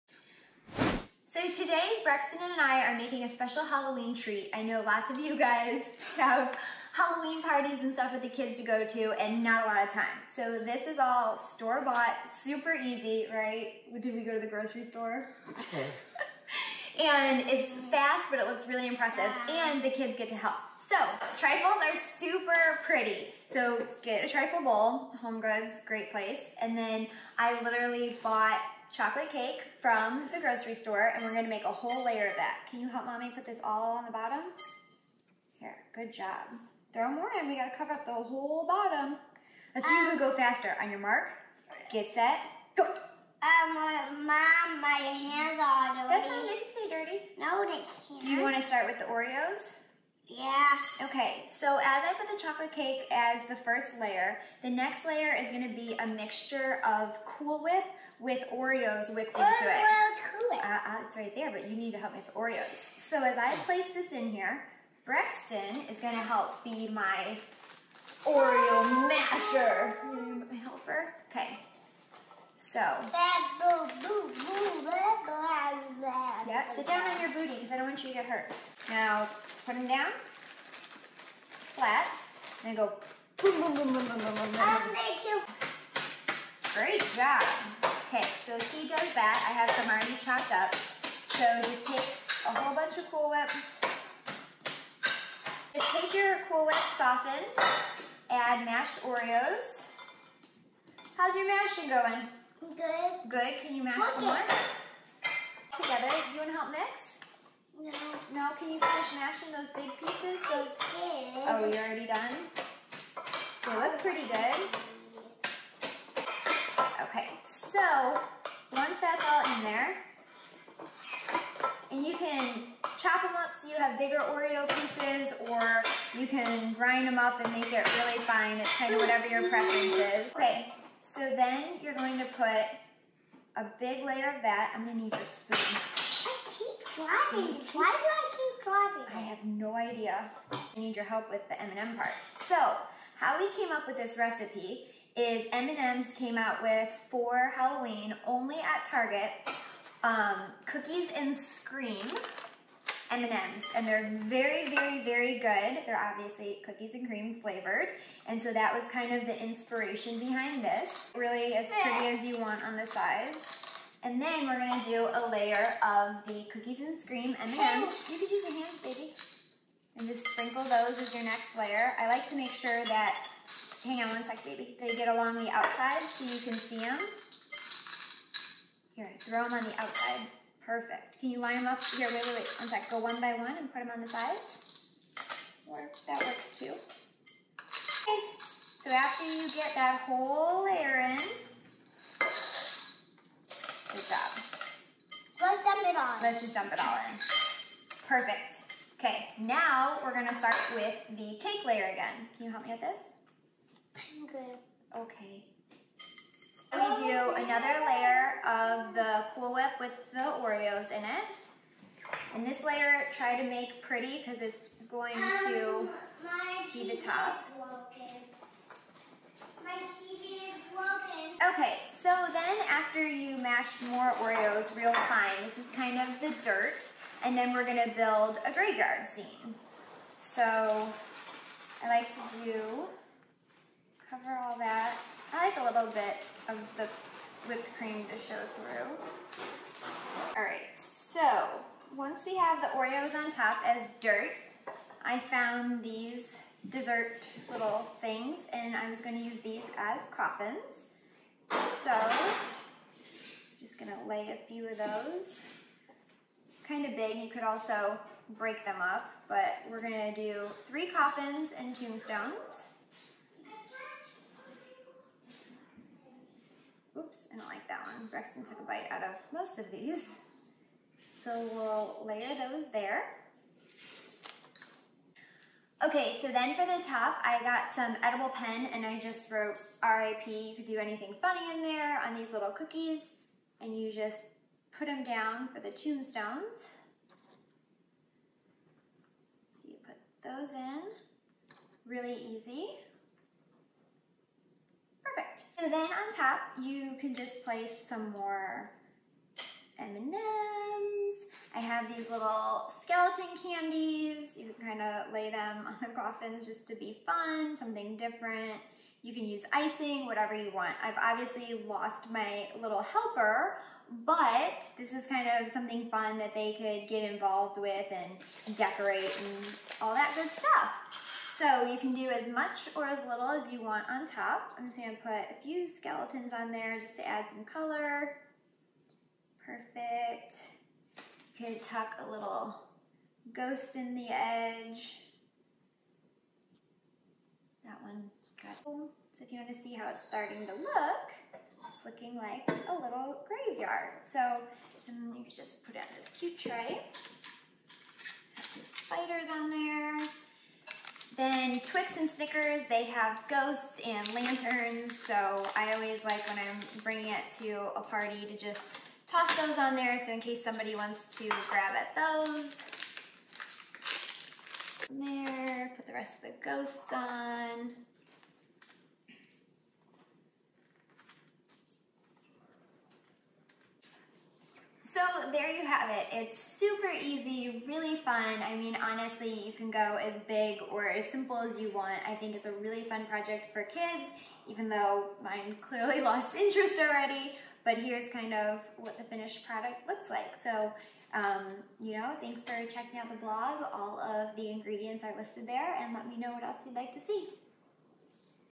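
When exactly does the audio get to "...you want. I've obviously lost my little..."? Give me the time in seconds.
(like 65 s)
310 s.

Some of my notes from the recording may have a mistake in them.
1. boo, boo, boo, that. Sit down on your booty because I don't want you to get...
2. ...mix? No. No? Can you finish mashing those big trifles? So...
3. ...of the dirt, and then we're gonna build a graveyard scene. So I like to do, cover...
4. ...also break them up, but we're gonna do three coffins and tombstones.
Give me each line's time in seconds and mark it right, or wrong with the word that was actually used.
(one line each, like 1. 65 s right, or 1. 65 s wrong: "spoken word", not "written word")
1. 73 s right
2. 106 s wrong: "pieces", not "trifles"
3. 225 s right
4. 257 s right.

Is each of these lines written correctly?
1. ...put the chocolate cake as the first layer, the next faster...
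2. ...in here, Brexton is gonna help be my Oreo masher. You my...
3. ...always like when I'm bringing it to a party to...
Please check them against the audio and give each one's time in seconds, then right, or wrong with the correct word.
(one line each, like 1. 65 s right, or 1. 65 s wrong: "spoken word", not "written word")
1. 52 s wrong: "layer", not "faster"
2. 64 s right
3. 355 s right.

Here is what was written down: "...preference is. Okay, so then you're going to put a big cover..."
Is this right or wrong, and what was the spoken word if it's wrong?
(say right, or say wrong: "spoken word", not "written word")
wrong: "layer", not "cover".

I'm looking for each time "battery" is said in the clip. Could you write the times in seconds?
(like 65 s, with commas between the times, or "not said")
not said.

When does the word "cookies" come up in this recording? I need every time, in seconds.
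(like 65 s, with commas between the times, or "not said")
150 s, 156 s, 166 s, 282 s.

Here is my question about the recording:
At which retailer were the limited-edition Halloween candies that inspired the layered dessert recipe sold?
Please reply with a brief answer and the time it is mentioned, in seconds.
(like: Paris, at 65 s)
Target, at 148 s.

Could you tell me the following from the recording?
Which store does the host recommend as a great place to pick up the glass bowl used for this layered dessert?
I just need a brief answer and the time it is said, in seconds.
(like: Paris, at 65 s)
Home Goods, at 25 s.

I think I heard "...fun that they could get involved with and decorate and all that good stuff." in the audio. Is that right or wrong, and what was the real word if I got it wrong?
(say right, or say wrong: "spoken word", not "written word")
right.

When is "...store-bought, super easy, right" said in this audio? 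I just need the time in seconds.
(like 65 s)
11 s.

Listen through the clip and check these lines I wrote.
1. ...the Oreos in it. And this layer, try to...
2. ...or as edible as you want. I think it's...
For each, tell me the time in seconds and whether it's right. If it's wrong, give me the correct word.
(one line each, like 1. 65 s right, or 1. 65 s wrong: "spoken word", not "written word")
1. 210 s right
2. 380 s wrong: "simple", not "edible".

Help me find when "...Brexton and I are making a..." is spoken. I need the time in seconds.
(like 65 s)
2 s.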